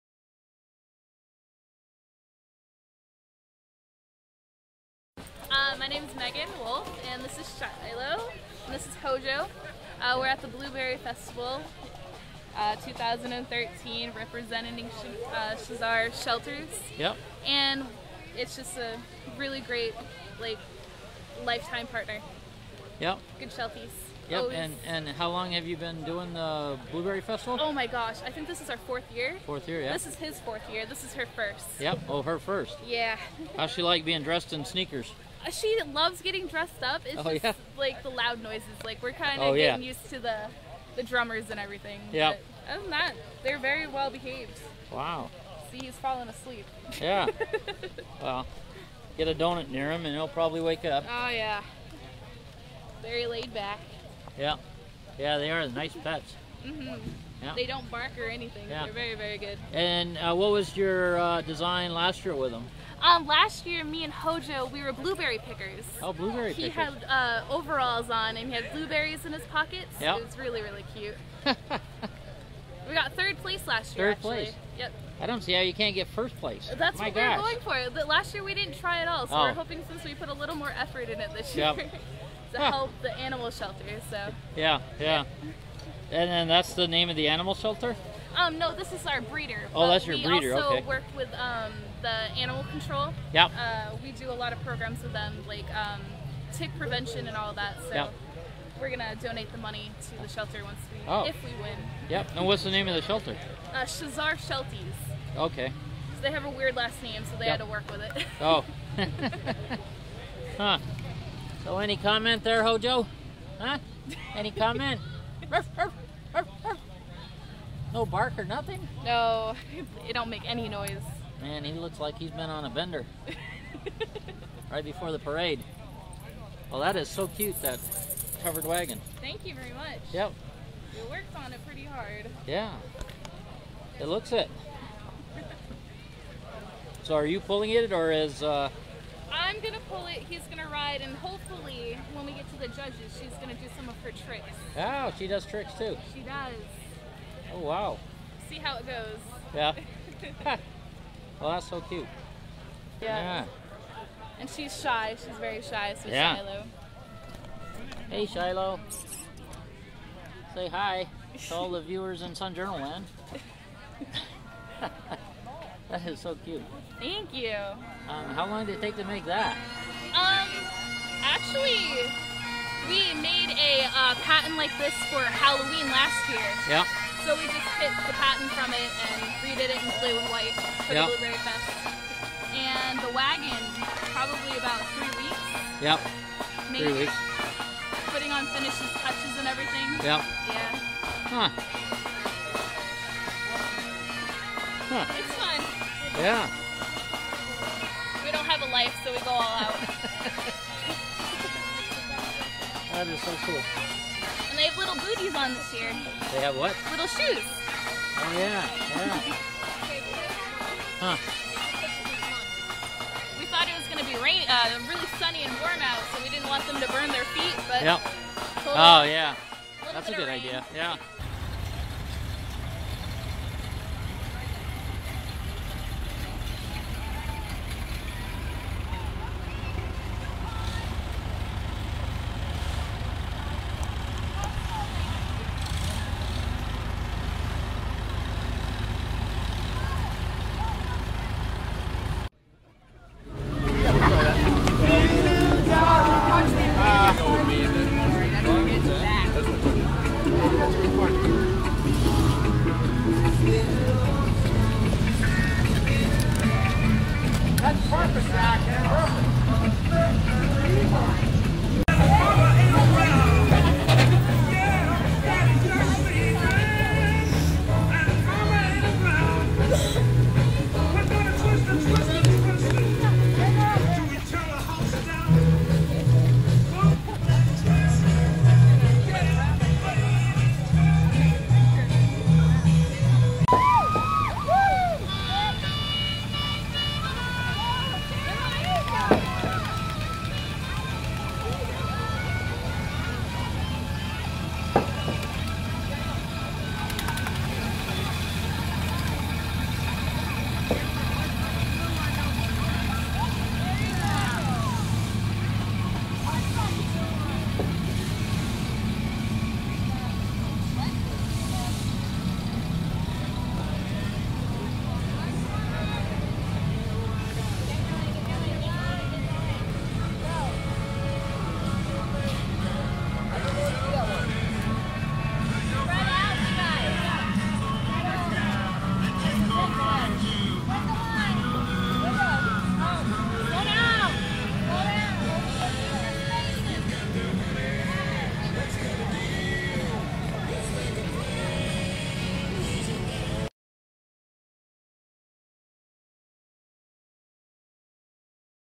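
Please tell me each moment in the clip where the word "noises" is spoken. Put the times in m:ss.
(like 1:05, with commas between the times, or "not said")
0:38, 2:00.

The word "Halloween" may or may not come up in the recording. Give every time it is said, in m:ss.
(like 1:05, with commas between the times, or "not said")
2:55.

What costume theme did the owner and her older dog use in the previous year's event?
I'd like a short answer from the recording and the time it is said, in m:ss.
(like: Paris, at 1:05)
Blueberry pickers, at 1:04.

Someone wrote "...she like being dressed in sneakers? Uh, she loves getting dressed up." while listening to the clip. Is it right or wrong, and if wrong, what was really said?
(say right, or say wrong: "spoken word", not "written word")
right.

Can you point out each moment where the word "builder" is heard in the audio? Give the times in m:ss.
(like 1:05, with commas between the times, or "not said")
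not said.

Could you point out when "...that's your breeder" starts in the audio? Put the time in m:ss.
1:29.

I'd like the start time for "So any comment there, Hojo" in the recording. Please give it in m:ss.
1:51.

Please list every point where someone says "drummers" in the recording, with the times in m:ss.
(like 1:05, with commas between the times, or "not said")
0:41.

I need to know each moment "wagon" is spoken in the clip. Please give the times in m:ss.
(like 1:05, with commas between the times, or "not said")
2:08, 3:03.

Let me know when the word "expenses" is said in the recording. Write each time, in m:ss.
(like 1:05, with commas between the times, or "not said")
not said.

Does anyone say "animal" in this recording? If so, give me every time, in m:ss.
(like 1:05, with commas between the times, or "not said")
1:23, 1:27, 1:32.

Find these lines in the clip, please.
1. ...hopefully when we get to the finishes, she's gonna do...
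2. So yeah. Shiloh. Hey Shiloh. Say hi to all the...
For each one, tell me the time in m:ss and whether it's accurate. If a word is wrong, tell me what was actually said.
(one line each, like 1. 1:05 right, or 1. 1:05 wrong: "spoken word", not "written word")
1. 2:21 wrong: "judges", not "finishes"
2. 2:36 right.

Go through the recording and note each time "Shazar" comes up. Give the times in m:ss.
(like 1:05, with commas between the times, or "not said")
0:15, 1:43.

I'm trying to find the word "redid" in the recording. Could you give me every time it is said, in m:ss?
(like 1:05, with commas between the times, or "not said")
2:59.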